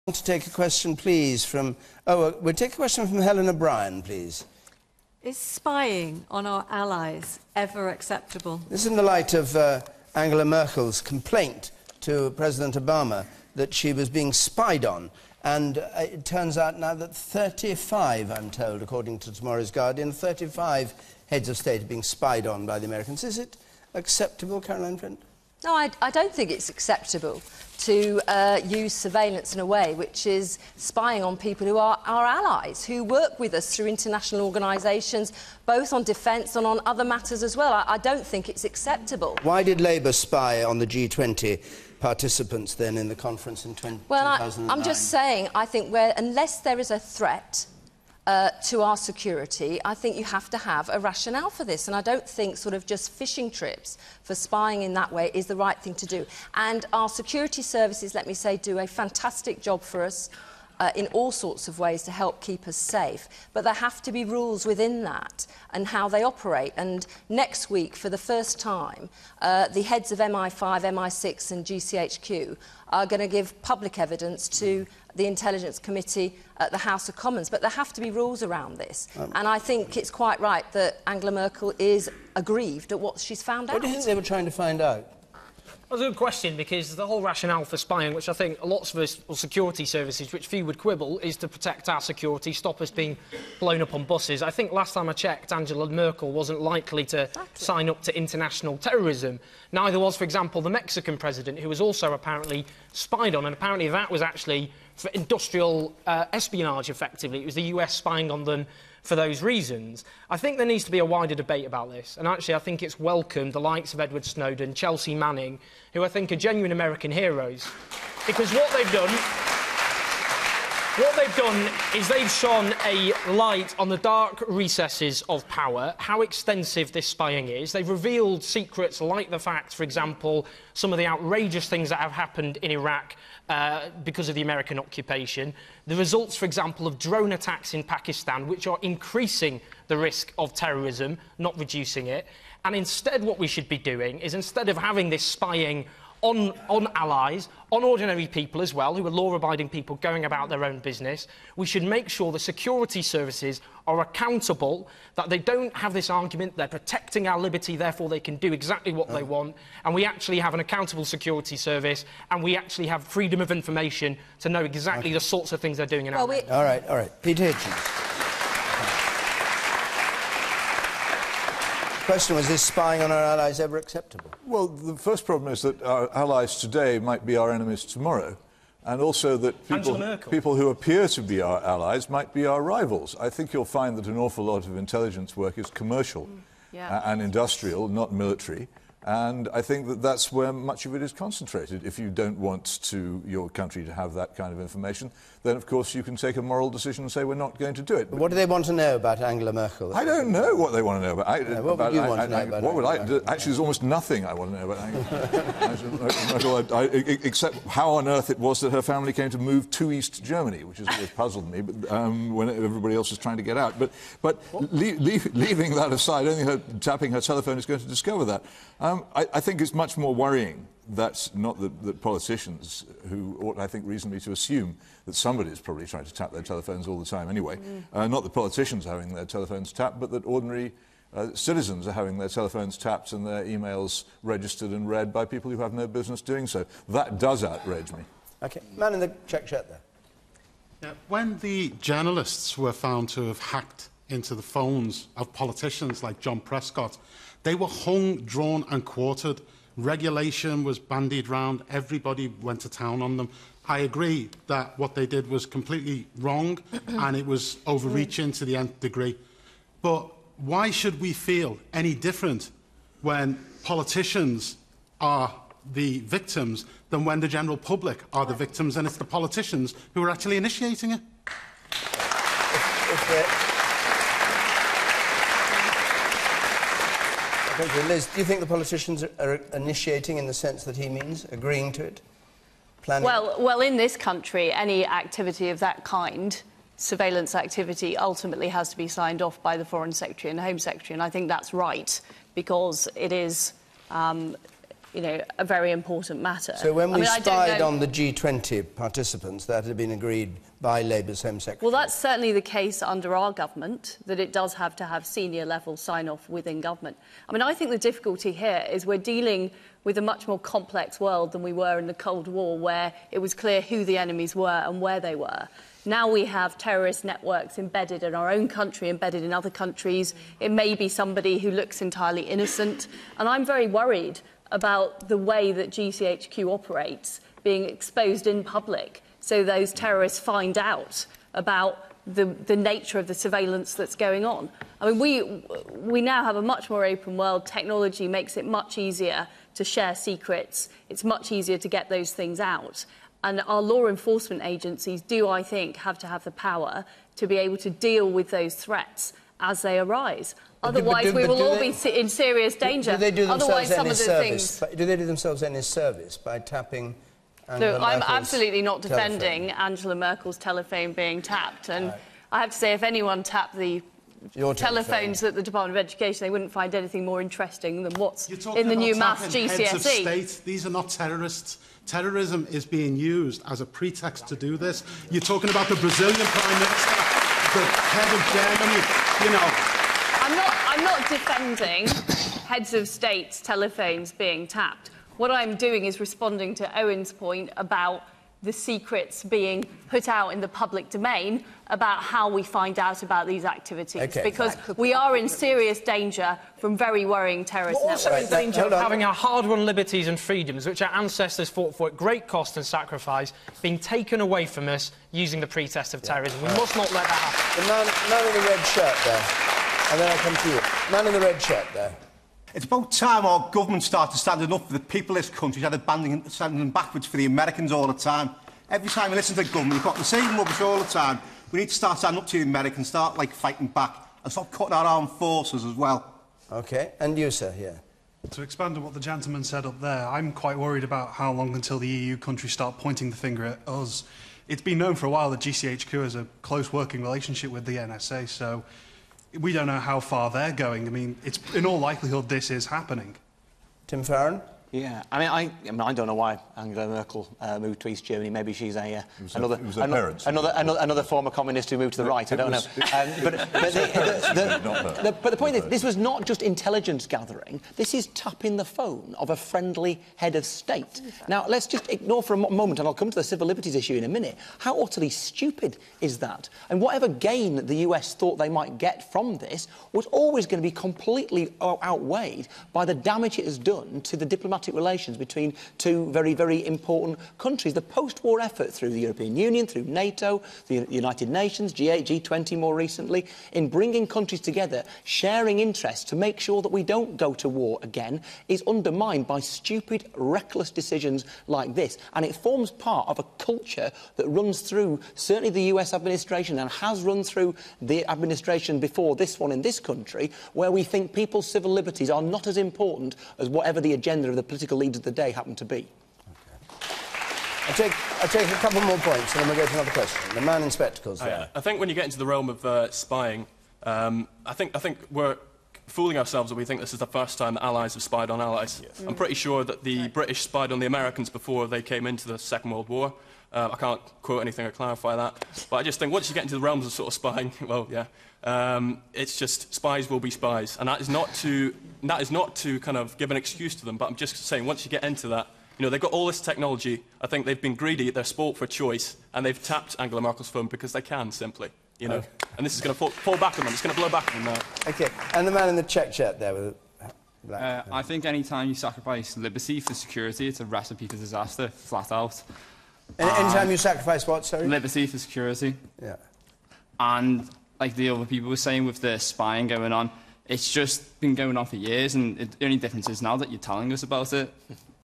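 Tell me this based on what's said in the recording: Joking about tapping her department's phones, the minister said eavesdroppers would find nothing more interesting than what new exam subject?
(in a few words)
maths GCSE.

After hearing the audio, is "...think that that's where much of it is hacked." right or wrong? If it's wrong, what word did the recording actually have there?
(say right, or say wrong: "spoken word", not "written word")
wrong: "concentrated", not "hacked".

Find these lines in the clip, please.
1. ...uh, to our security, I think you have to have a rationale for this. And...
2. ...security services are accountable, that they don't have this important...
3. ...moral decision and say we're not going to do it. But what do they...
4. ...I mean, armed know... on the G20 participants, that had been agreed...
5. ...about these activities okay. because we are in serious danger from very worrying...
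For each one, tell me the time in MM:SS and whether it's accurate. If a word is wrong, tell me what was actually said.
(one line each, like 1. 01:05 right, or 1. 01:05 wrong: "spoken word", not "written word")
1. 00:48 right
2. 02:32 wrong: "argument", not "important"
3. 03:16 right
4. 04:56 wrong: "spied", not "armed"
5. 06:33 right.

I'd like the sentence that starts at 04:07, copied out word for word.
They were hung, drawn, and quartered.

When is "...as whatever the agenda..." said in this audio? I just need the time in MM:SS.
08:23.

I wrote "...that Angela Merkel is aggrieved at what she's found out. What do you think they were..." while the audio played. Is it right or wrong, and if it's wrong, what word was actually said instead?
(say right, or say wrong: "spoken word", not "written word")
right.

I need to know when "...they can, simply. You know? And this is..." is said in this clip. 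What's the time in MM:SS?
09:00.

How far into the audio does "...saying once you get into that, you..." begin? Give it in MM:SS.
08:54.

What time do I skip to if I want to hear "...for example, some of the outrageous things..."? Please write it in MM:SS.
02:09.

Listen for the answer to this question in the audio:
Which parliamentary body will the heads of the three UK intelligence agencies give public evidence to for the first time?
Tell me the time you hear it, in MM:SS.
01:15.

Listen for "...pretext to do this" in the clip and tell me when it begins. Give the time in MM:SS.
06:13.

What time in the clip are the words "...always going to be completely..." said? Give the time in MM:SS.
07:50.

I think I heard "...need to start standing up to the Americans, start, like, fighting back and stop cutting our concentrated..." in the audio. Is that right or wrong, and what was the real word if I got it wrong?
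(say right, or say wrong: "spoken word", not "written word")
wrong: "armed", not "concentrated".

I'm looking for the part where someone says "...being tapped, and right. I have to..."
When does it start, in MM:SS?
06:00.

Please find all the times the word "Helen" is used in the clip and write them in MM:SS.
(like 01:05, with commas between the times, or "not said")
00:03.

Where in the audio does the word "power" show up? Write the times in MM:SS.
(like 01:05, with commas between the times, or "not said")
02:05, 05:46.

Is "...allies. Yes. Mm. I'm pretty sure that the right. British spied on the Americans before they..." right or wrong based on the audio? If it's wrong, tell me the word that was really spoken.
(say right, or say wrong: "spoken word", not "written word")
right.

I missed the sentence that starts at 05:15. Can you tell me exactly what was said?
Now we have terrorist networks embedded in our own country, embedded in other countries.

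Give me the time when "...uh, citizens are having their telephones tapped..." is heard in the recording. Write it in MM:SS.
03:51.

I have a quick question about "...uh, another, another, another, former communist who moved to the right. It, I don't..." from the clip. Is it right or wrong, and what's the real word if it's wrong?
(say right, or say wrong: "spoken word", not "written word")
right.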